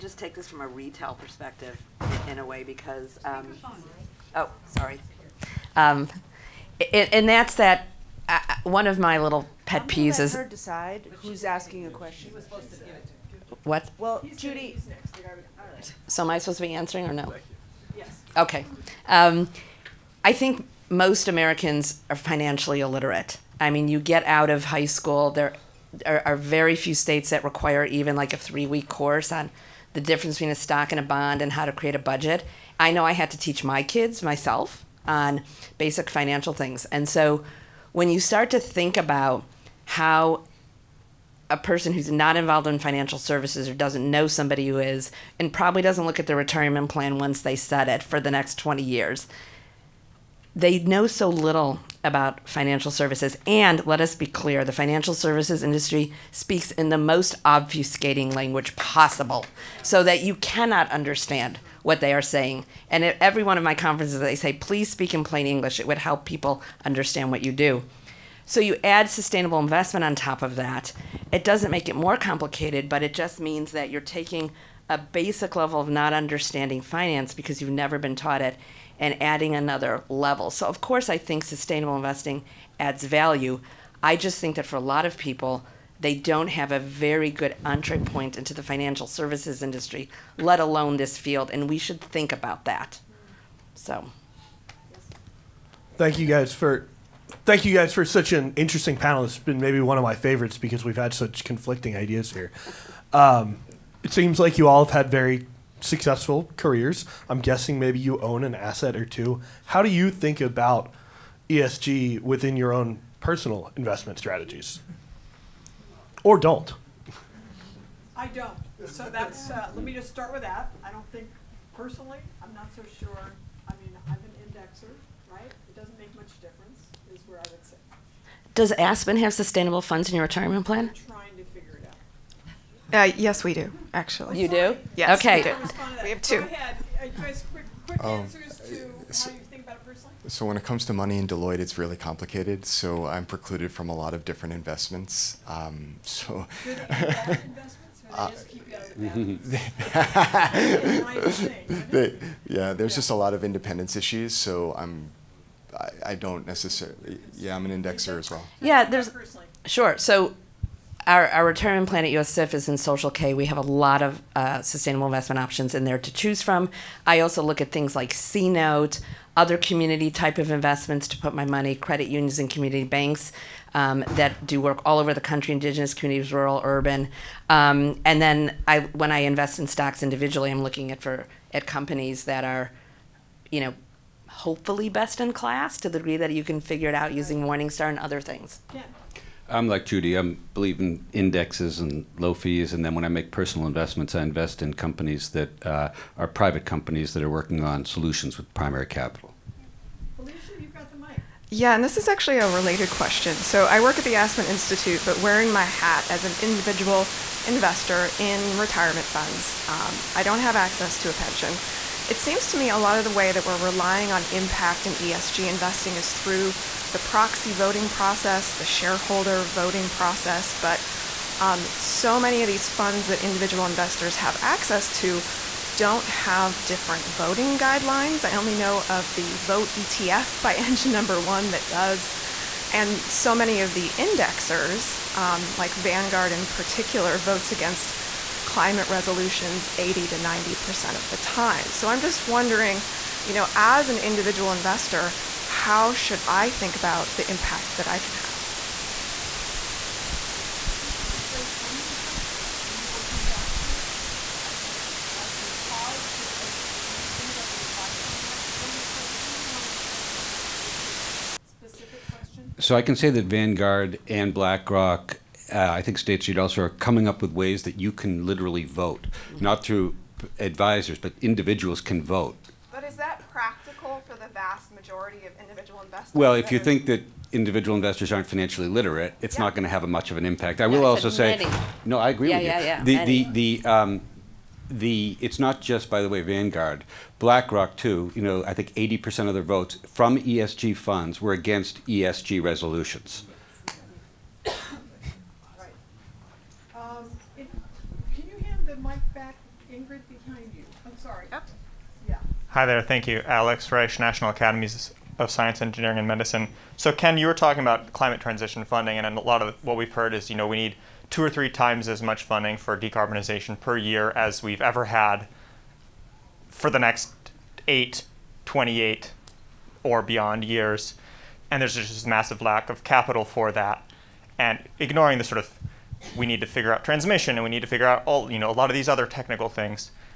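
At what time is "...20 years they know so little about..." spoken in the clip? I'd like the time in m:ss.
0:48.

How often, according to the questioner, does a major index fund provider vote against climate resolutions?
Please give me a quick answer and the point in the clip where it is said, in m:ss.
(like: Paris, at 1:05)
80 to 90%, at 3:59.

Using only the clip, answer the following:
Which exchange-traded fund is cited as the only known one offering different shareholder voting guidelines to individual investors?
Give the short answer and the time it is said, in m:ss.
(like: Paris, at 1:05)
Vote ETF, at 3:49.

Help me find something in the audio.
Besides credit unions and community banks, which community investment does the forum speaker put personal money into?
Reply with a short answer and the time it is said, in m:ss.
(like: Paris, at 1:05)
CNote, at 2:48.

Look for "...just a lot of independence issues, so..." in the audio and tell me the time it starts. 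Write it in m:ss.
2:32.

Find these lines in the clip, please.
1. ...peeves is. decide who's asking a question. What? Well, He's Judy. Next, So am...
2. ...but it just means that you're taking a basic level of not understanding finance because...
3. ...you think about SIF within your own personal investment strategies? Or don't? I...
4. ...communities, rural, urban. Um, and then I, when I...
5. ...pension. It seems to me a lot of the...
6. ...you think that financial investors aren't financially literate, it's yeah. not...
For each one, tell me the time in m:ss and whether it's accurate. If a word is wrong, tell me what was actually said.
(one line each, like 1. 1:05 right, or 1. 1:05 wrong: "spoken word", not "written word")
1. 0:09 right
2. 1:12 right
3. 1:49 wrong: "ESG", not "SIF"
4. 2:55 right
5. 3:31 right
6. 4:36 wrong: "individual", not "financial".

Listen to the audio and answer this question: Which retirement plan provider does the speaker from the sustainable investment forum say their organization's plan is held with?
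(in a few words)
Social(k).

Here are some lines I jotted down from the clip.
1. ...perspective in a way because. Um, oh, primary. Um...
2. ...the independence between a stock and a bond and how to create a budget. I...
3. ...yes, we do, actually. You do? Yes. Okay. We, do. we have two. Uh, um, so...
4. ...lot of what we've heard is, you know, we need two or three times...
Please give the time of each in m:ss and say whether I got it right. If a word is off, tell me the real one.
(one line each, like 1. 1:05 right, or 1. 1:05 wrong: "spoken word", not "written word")
1. 0:01 wrong: "sorry", not "primary"
2. 0:29 wrong: "difference", not "independence"
3. 2:13 right
4. 5:09 right.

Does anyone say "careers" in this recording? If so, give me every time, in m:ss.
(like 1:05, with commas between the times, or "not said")
1:46.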